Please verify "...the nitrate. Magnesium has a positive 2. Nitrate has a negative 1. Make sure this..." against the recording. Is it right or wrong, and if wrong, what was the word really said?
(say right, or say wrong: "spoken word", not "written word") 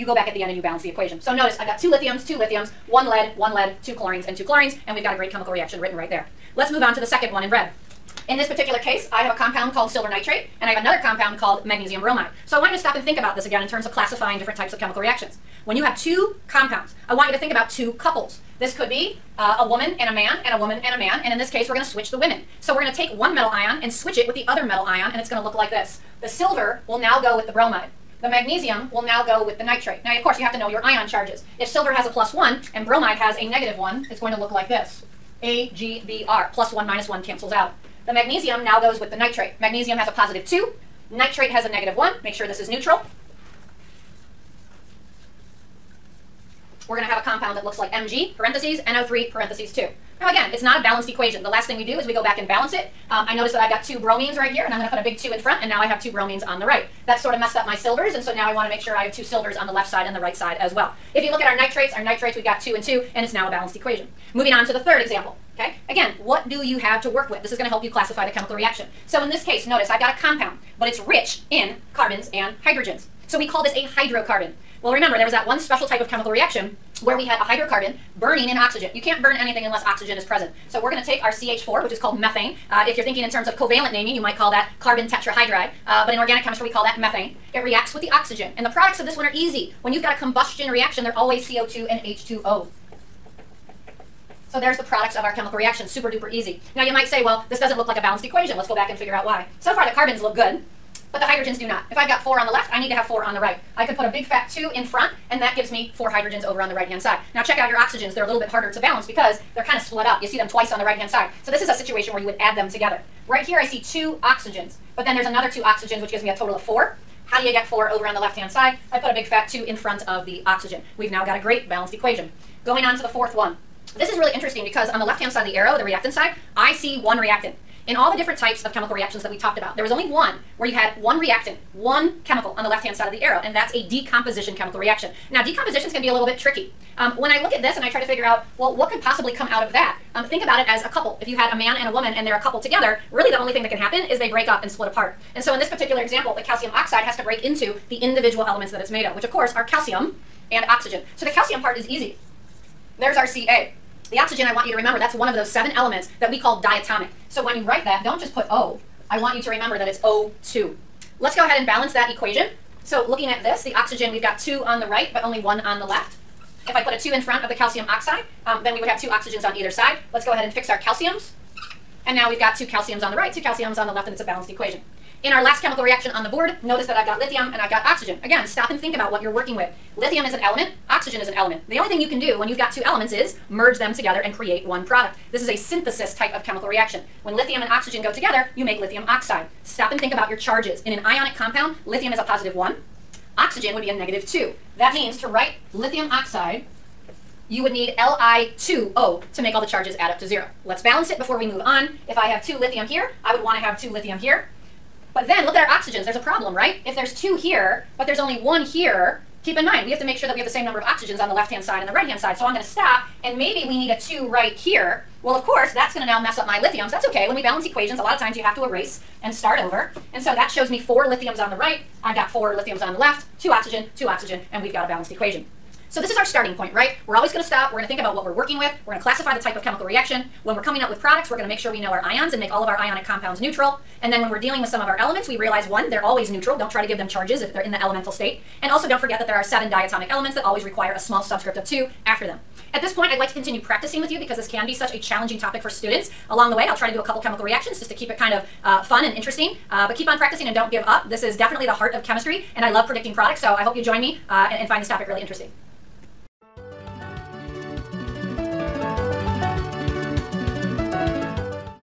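right.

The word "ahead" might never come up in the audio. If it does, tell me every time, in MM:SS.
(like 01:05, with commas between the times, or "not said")
02:41, 02:50.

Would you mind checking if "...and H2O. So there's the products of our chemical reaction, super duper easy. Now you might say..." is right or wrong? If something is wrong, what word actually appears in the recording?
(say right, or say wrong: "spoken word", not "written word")
right.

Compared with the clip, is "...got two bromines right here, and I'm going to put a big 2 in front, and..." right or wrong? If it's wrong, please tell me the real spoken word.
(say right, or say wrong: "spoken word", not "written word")
right.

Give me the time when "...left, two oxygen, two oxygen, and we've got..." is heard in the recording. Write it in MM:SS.
03:42.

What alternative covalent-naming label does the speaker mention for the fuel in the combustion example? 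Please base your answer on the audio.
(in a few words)
Carbon tetrahydride.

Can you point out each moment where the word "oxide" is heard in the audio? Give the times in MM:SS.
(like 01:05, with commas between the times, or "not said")
02:26, 02:47, 03:09, 03:16.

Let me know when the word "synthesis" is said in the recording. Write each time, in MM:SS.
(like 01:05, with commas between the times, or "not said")
03:05.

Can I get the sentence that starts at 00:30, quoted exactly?
Now, of course, you have to know your ion charges.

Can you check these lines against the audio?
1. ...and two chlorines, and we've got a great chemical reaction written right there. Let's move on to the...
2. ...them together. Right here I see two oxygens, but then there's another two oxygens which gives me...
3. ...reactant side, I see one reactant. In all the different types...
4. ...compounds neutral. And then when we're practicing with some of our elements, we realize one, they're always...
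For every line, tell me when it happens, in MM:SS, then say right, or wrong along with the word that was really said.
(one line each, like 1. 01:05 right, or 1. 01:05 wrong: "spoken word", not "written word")
1. 00:04 right
2. 01:52 right
3. 02:05 right
4. 03:53 wrong: "dealing", not "practicing".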